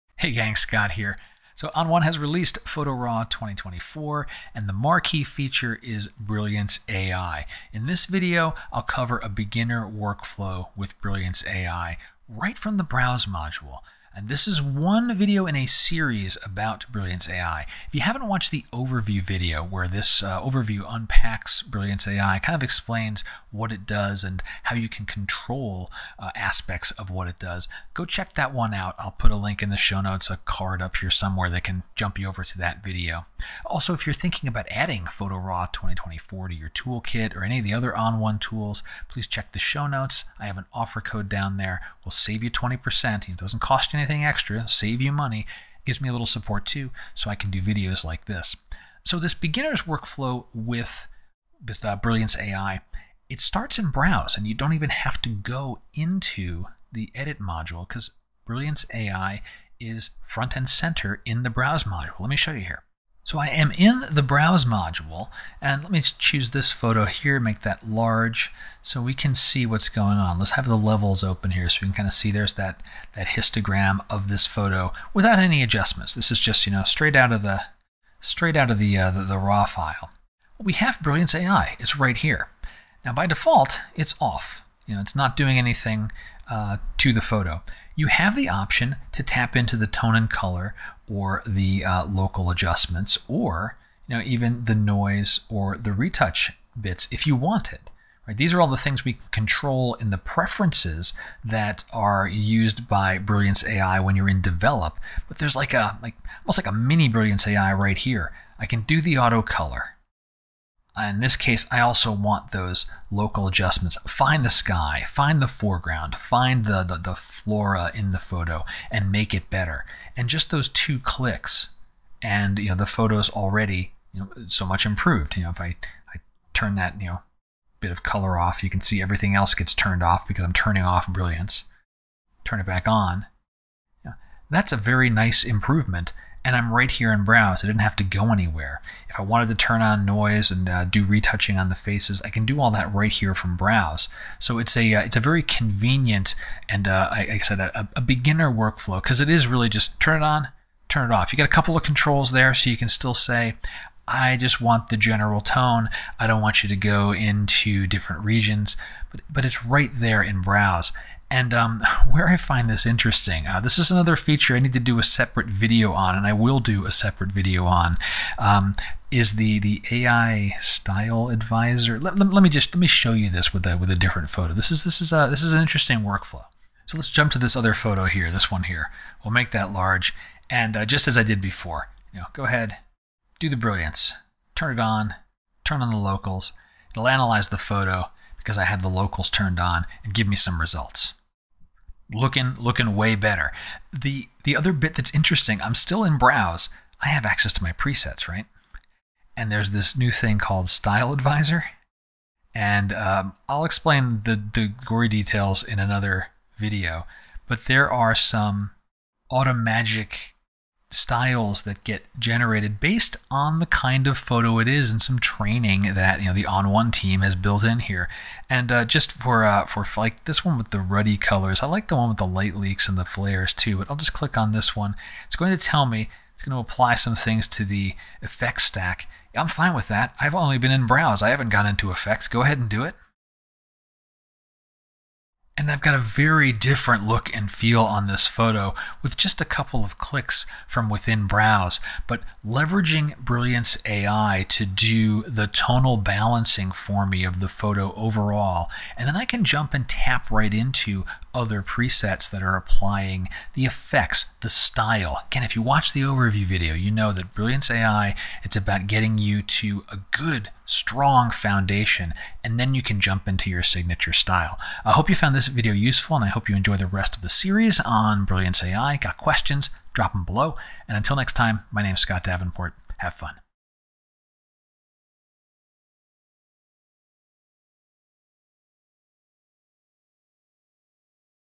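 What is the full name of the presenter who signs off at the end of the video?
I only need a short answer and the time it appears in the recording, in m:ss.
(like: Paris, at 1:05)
Scott Davenport, at 4:32.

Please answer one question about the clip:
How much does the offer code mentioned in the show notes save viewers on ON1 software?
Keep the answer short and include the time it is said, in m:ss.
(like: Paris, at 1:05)
20%, at 0:42.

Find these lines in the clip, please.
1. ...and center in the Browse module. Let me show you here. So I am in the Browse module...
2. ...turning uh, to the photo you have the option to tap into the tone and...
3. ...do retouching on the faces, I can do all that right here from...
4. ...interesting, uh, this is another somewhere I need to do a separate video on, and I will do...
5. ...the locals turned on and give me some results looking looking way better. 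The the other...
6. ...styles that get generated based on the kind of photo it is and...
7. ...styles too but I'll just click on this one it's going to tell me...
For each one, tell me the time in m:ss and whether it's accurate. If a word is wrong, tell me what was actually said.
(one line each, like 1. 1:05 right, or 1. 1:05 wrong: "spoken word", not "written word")
1. 1:00 right
2. 1:25 wrong: "anything", not "turning"
3. 2:20 right
4. 2:42 wrong: "feature", not "somewhere"
5. 3:08 right
6. 3:30 right
7. 3:43 wrong: "flares", not "styles".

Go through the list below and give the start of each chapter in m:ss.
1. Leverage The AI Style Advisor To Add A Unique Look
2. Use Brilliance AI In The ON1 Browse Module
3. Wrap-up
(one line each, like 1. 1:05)
1. 2:41
2. 0:49
3. 4:02.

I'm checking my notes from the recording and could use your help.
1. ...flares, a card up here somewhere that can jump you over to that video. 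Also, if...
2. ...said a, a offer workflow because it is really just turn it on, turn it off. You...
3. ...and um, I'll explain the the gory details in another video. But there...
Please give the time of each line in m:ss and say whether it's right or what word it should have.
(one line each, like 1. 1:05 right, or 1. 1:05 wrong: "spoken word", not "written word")
1. 0:30 wrong: "notes", not "flares"
2. 2:27 wrong: "beginner", not "offer"
3. 3:22 right.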